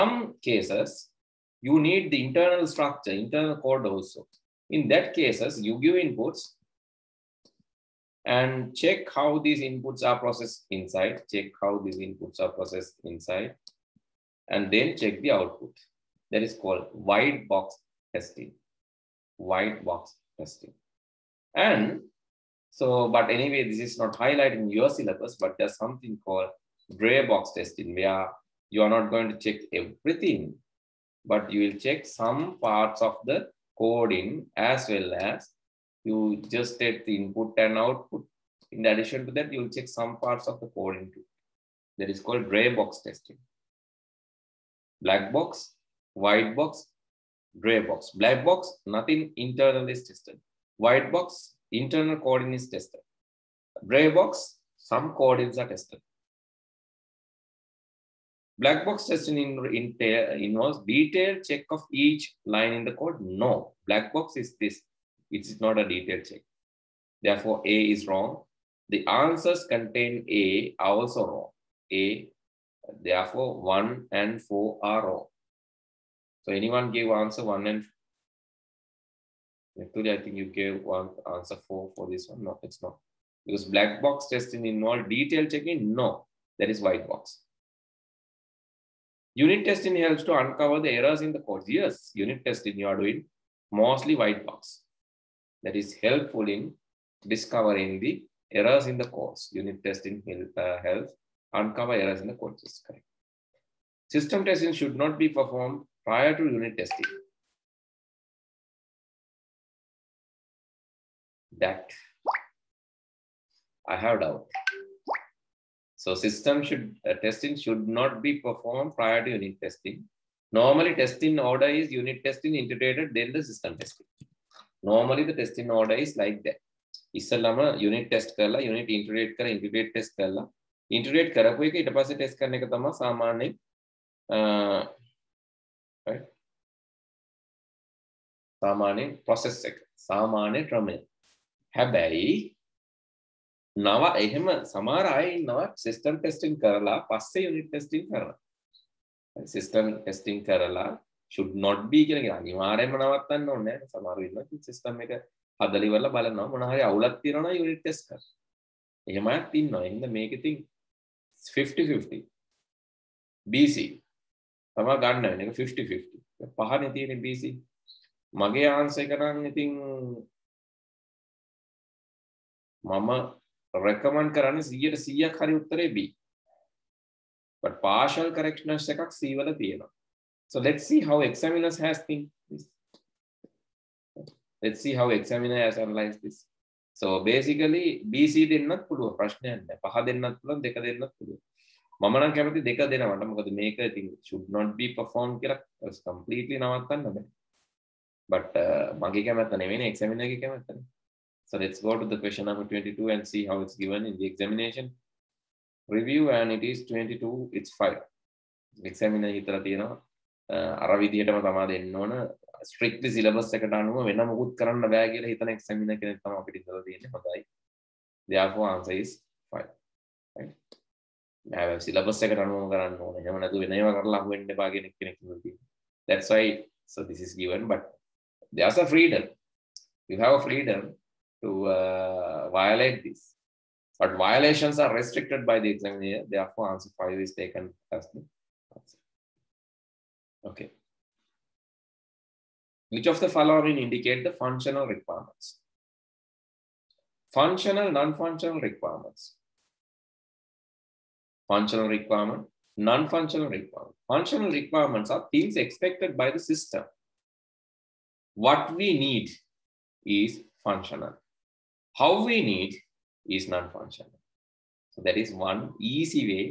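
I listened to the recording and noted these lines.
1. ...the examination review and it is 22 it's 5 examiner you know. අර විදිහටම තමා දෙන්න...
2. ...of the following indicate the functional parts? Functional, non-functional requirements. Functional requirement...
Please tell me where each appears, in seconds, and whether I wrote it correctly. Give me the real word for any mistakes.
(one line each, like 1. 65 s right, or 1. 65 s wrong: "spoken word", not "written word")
1. 204 s right
2. 243 s wrong: "requirements", not "parts".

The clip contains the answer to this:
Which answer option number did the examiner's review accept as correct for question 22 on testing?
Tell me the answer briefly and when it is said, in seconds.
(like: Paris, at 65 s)
5, at 218 s.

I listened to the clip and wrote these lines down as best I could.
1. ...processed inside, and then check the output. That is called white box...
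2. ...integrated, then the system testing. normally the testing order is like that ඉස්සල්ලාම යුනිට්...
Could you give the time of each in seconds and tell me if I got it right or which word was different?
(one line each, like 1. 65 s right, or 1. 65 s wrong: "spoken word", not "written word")
1. 12 s right
2. 122 s right.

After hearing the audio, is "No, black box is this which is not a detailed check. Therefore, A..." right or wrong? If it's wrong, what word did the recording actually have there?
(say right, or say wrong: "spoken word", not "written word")
right.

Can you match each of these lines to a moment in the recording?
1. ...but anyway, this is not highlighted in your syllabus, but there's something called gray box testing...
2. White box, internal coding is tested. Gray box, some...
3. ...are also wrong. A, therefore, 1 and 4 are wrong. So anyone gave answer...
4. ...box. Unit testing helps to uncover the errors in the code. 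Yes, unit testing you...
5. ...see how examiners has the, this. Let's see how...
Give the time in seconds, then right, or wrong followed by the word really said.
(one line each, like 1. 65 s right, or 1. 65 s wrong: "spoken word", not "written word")
1. 23 s right
2. 50 s right
3. 70 s right
4. 87 s right
5. 180 s right.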